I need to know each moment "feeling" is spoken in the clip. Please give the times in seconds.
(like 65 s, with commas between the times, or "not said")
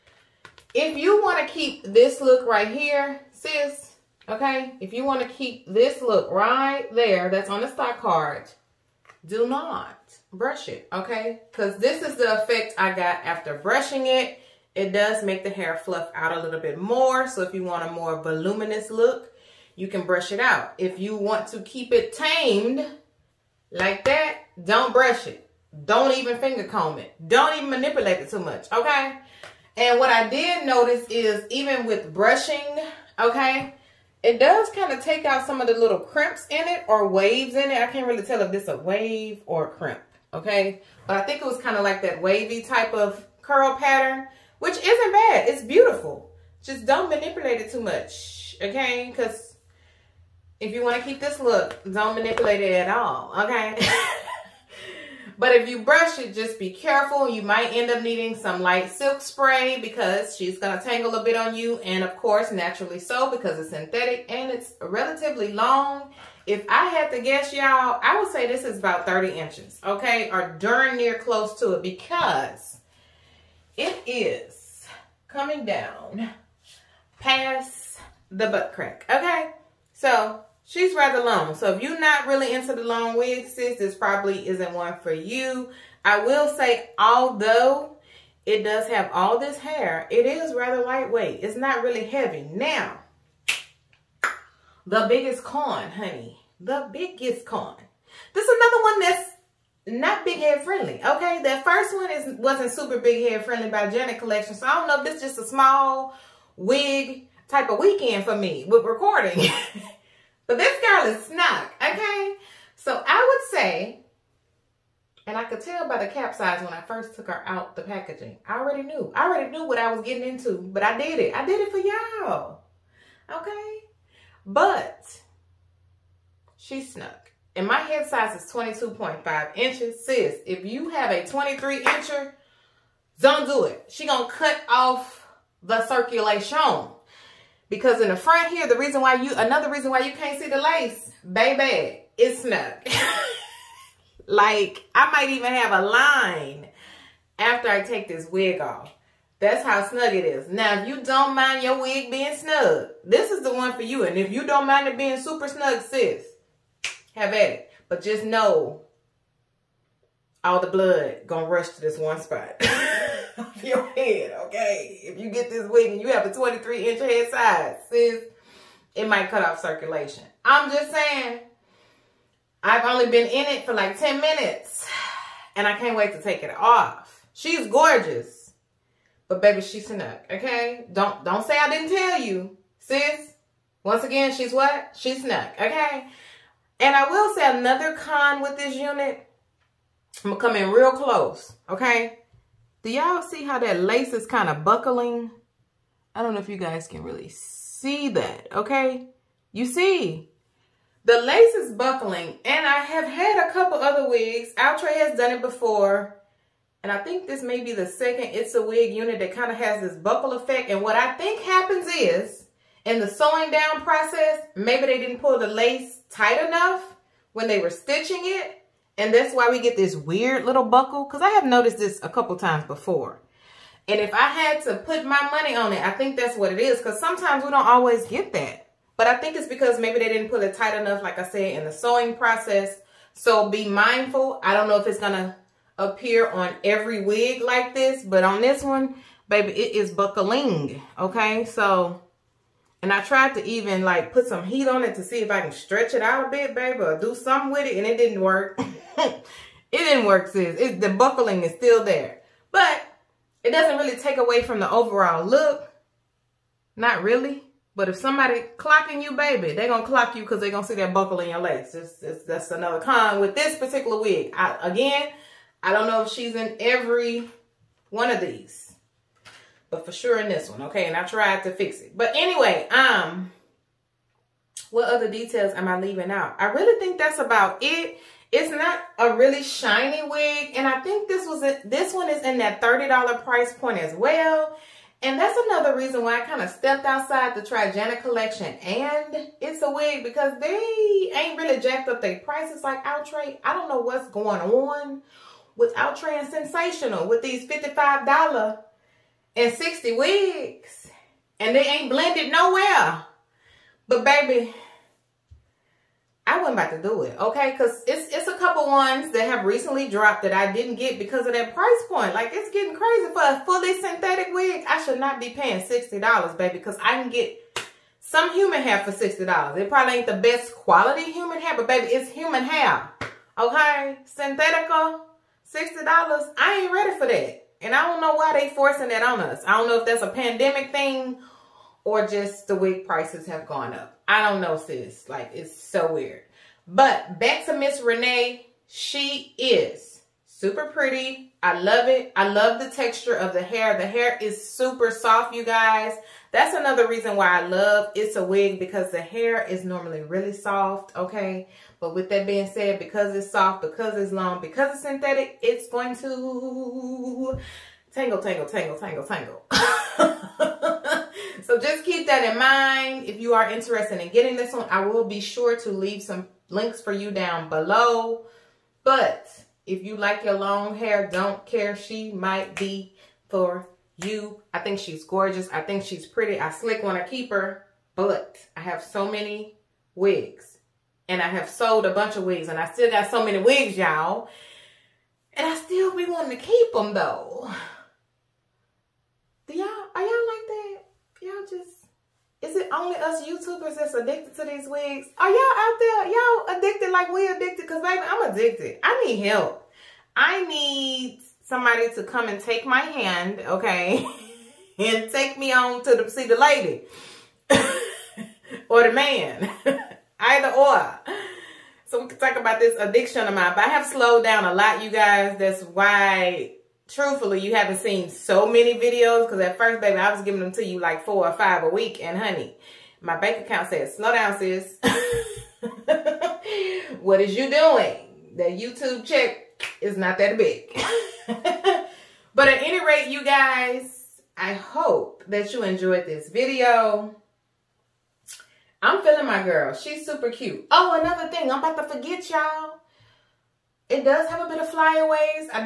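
439 s.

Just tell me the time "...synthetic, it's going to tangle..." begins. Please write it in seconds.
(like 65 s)
354 s.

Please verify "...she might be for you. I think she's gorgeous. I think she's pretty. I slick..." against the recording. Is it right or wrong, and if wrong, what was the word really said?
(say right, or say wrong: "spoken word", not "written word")
right.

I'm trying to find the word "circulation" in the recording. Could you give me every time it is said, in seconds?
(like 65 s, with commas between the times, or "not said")
135 s, 169 s.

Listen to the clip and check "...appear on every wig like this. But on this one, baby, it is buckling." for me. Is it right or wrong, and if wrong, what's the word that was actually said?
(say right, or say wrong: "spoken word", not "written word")
right.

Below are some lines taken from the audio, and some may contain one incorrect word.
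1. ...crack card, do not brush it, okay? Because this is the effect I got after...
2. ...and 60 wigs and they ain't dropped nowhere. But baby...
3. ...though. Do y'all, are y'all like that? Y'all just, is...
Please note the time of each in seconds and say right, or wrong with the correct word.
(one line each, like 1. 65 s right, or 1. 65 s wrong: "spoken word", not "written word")
1. 7 s wrong: "stock", not "crack"
2. 299 s wrong: "blended", not "dropped"
3. 386 s right.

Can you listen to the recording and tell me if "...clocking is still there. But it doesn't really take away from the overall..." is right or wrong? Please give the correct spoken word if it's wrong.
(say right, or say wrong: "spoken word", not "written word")
wrong: "buckling", not "clocking".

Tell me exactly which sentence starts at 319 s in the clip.
It probably ain't the best quality human hair, but baby, it's human hair, okay?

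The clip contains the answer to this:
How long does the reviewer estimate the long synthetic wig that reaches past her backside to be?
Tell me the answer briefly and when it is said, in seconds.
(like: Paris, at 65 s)
30 inches, at 69 s.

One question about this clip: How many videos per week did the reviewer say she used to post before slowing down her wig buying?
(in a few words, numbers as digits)
4 or 5.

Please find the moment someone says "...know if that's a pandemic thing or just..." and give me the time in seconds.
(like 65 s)
329 s.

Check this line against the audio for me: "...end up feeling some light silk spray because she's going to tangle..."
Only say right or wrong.
wrong.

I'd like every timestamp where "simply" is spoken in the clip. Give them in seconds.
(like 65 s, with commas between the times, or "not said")
not said.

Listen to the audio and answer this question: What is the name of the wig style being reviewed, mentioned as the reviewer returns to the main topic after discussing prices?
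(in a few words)
Renae.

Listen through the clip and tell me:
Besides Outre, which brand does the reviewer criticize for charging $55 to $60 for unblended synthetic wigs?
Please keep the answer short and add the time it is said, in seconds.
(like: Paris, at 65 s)
Sensational, at 296 s.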